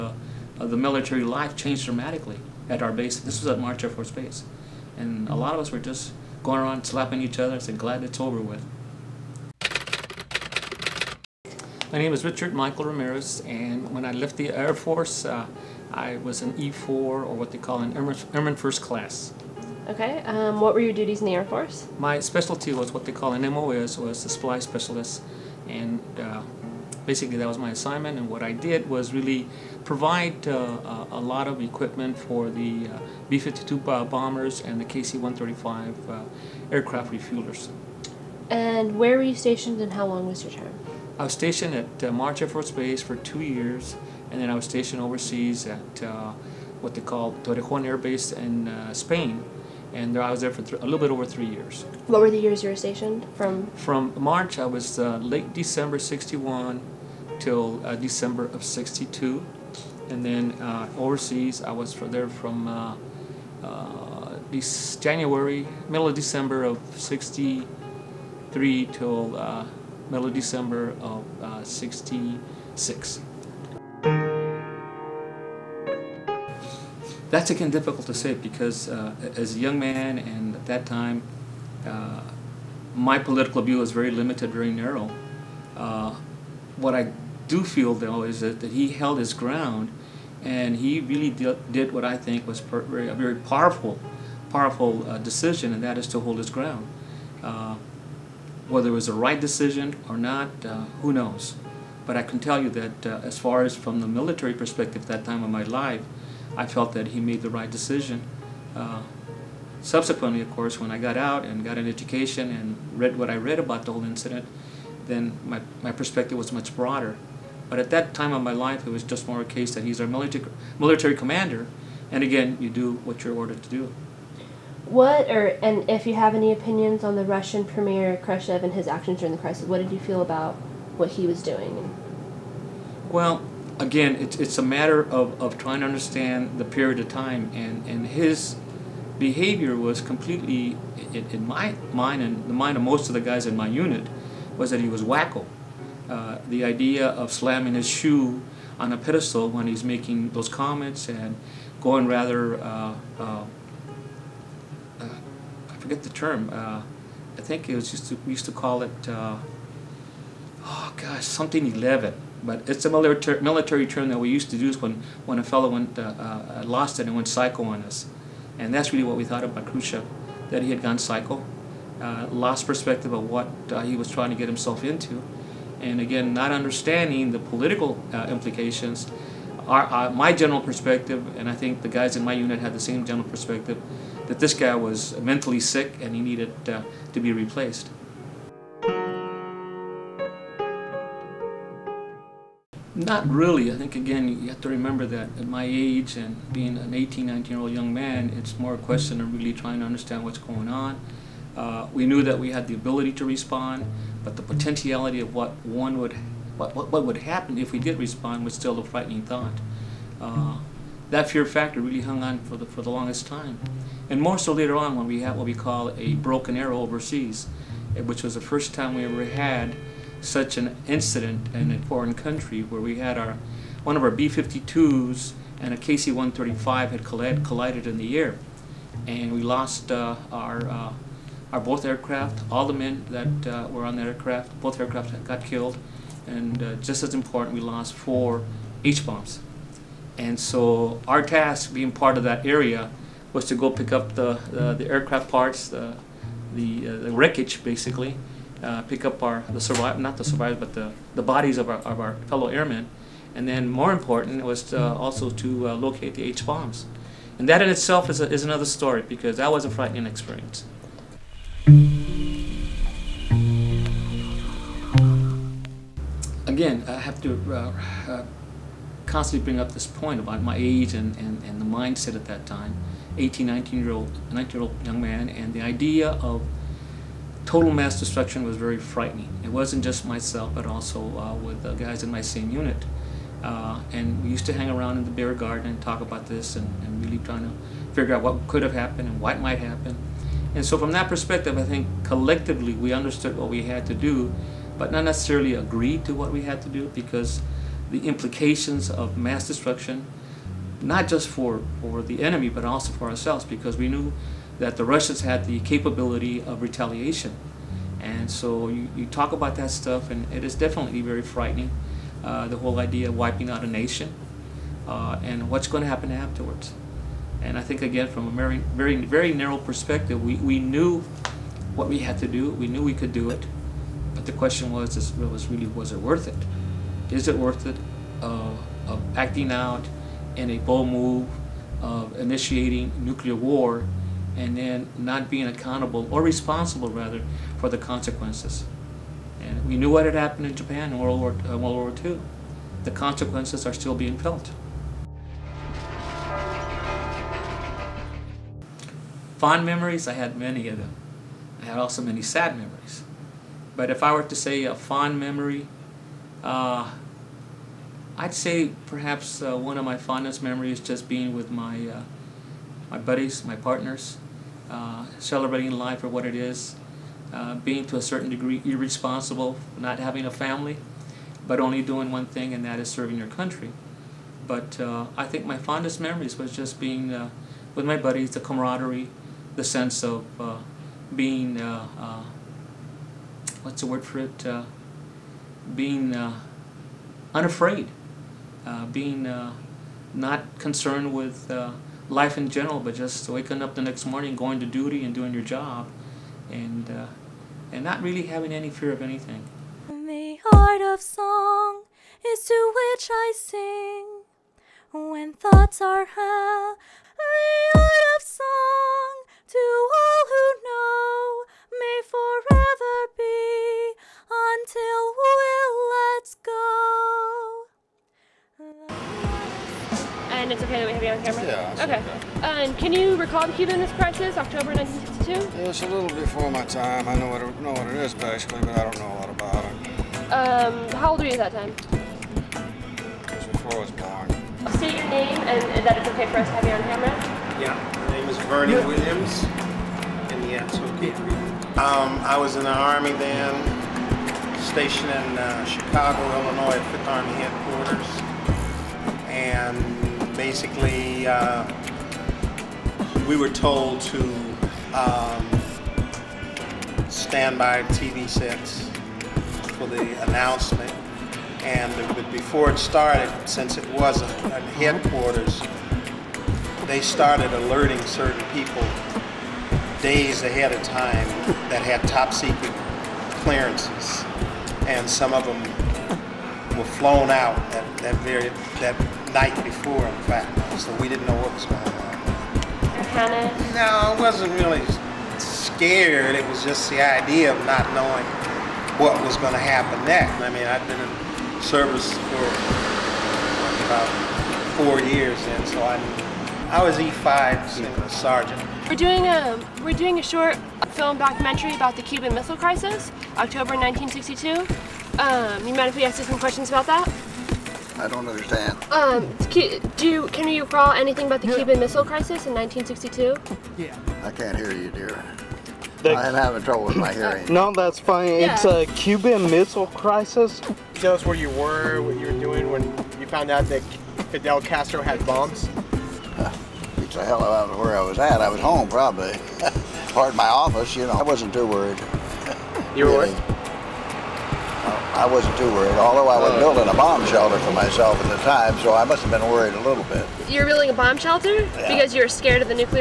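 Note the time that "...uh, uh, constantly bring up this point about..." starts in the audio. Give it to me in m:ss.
4:27.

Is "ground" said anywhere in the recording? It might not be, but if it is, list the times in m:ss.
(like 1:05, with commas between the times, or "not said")
1:29, 1:36.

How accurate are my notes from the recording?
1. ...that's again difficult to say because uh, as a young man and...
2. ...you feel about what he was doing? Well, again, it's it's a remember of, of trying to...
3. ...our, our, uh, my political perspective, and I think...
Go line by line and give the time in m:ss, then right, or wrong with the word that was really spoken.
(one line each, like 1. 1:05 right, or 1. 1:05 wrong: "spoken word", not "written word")
1. 1:17 right
2. 2:09 wrong: "matter", not "remember"
3. 2:59 wrong: "general", not "political".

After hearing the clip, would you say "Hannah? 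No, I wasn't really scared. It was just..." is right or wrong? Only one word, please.
right.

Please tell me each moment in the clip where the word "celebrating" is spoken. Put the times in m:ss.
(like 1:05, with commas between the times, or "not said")
6:05.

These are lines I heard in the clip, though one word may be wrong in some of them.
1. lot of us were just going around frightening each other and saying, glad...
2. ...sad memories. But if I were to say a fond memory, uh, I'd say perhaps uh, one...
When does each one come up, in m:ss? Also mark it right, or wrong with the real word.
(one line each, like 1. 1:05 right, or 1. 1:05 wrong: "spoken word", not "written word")
1. 0:05 wrong: "slapping", not "frightening"
2. 5:52 right.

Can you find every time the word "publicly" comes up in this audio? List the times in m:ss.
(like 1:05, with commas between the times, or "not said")
not said.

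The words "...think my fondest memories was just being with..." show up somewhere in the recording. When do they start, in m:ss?
6:15.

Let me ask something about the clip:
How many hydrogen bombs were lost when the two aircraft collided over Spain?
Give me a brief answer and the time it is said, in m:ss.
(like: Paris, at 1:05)
4, at 3:57.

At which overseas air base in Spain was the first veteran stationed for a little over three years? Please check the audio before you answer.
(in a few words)
Torrejon Air Base.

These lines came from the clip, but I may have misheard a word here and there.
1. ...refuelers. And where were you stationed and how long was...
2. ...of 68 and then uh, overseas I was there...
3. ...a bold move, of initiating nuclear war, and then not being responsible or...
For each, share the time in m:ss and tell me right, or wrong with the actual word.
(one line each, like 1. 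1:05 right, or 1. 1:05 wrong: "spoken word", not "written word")
1. 0:37 right
2. 0:58 wrong: "62", not "68"
3. 5:30 wrong: "accountable", not "responsible".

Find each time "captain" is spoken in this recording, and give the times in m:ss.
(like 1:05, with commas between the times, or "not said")
not said.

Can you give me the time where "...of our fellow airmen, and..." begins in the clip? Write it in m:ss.
4:11.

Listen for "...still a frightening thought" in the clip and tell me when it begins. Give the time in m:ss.
3:28.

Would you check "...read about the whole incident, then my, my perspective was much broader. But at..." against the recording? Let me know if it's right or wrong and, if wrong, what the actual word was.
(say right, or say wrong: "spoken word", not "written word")
right.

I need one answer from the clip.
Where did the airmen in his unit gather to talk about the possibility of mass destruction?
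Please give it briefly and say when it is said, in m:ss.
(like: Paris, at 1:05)
beer garden, at 4:45.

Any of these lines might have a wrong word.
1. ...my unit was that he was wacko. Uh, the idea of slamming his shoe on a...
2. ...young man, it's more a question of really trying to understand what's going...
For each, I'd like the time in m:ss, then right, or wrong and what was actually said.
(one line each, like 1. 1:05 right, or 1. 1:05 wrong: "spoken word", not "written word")
1. 2:23 right
2. 3:17 right.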